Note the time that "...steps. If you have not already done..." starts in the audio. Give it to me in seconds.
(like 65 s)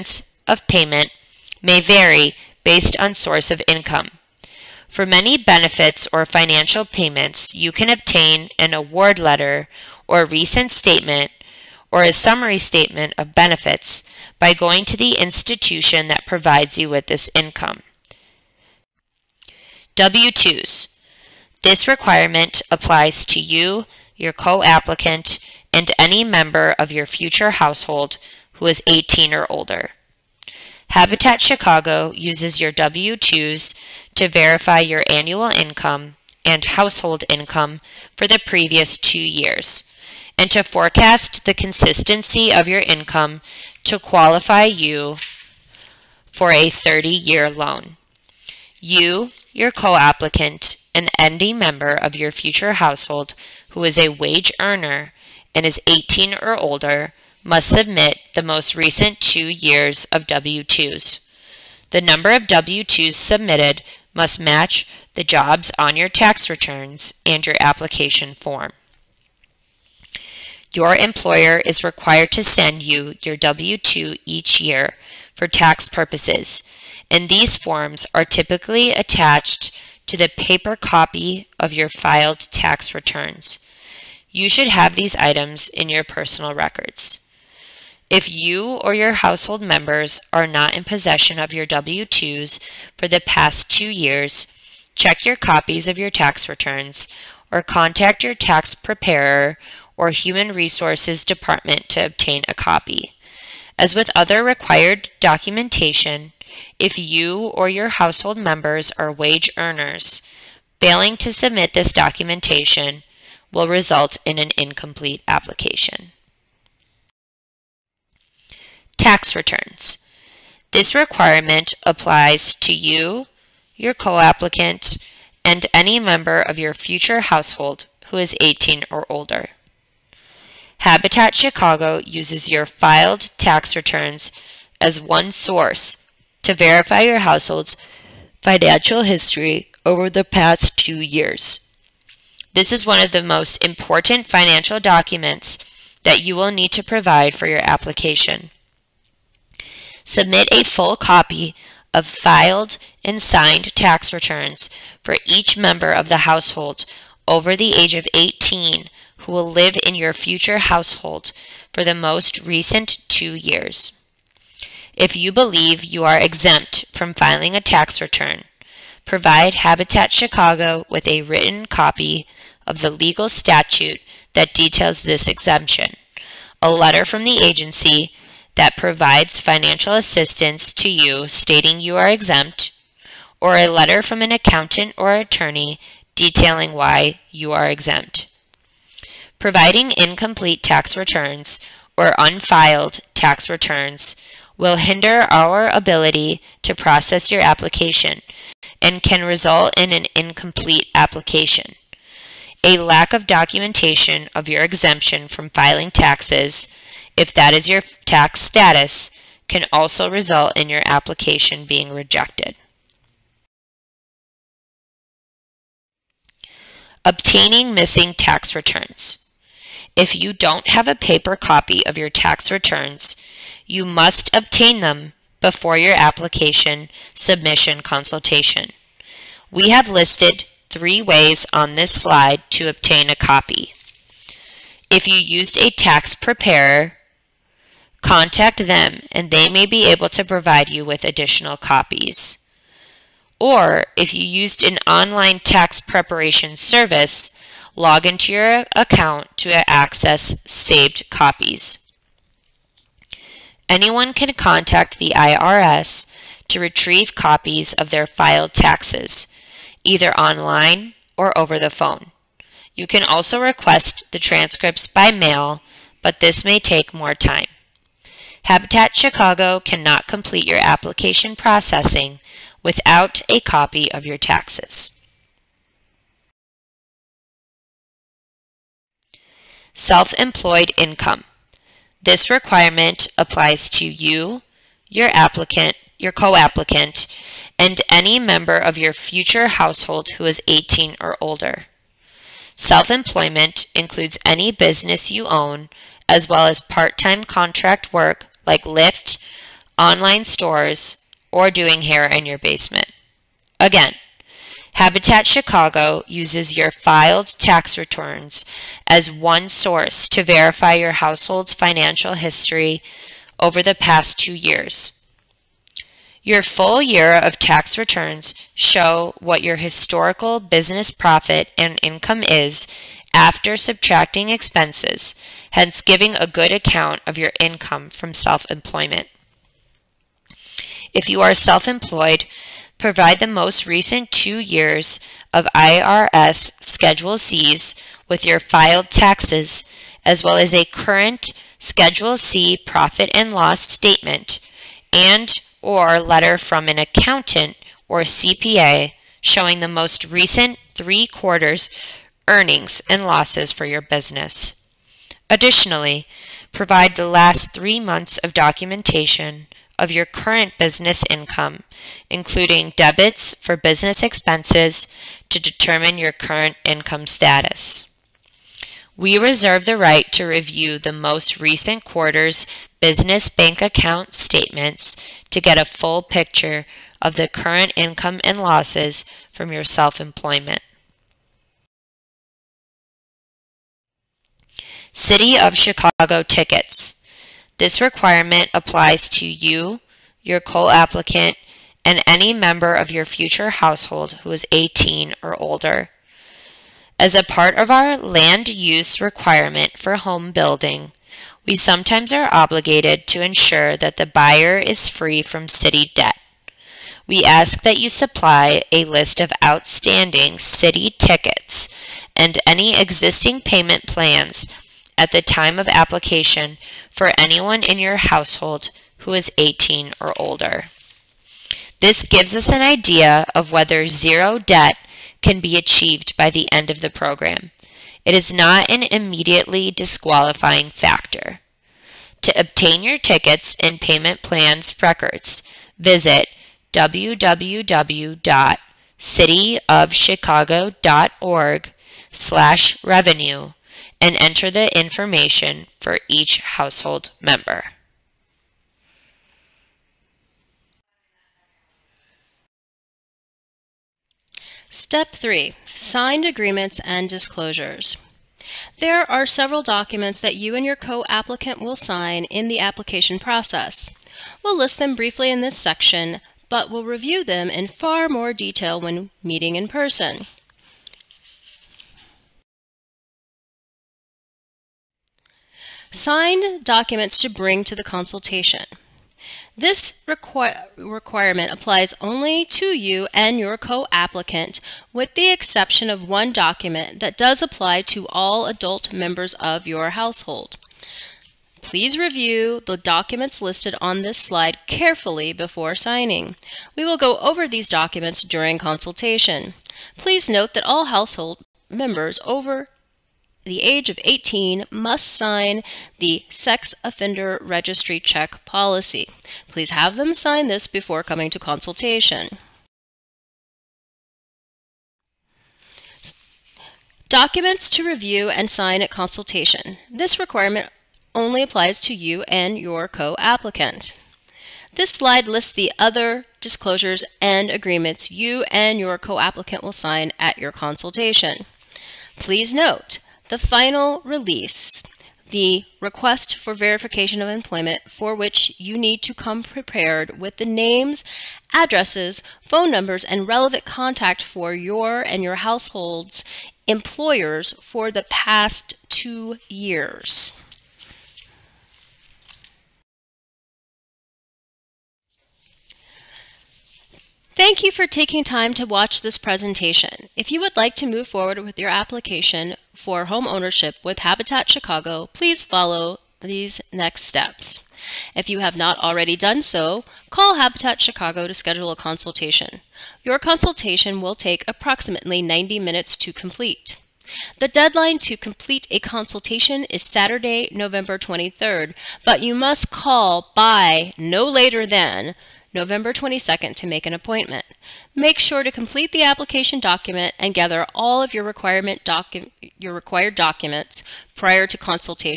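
567 s.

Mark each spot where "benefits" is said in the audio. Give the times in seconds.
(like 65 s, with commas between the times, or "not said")
5 s, 13 s.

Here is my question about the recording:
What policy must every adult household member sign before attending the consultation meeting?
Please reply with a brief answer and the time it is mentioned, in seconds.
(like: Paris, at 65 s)
Sex Offender Registry Check Policy, at 506 s.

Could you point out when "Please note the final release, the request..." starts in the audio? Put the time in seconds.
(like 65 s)
532 s.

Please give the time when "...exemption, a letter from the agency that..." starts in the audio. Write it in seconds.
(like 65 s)
175 s.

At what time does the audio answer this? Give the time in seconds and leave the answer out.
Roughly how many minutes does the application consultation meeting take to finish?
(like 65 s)
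575 s.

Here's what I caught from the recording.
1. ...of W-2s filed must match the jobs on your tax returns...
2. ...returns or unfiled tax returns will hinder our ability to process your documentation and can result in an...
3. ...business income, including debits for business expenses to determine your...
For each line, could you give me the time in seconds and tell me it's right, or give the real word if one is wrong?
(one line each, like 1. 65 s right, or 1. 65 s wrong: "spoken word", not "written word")
1. 62 s wrong: "submitted", not "filed"
2. 190 s wrong: "application", not "documentation"
3. 360 s right.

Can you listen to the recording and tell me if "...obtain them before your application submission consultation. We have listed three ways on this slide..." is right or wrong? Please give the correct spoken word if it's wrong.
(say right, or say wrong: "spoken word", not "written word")
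right.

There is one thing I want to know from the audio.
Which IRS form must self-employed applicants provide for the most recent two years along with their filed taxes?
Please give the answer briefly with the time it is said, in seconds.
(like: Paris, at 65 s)
Schedule C, at 336 s.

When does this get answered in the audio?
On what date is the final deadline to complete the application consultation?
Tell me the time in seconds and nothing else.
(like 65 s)
579 s.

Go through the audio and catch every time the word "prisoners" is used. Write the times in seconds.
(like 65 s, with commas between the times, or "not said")
not said.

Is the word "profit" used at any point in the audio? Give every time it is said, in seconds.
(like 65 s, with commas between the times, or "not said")
320 s, 342 s.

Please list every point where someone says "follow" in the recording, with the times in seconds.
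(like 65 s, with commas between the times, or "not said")
565 s.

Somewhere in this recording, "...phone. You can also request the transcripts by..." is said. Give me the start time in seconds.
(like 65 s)
261 s.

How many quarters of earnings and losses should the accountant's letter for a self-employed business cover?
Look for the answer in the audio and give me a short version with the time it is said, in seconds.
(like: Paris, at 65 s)
3, at 350 s.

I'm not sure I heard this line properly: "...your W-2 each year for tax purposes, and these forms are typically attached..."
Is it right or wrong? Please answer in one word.
right.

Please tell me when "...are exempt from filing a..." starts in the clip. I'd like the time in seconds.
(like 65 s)
166 s.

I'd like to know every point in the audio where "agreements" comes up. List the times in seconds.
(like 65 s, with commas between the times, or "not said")
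456 s, 527 s.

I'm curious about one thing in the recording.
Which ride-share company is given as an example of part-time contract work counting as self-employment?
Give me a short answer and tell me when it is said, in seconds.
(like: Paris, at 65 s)
Lyft, at 298 s.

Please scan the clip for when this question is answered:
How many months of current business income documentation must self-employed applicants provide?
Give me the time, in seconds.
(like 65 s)
357 s.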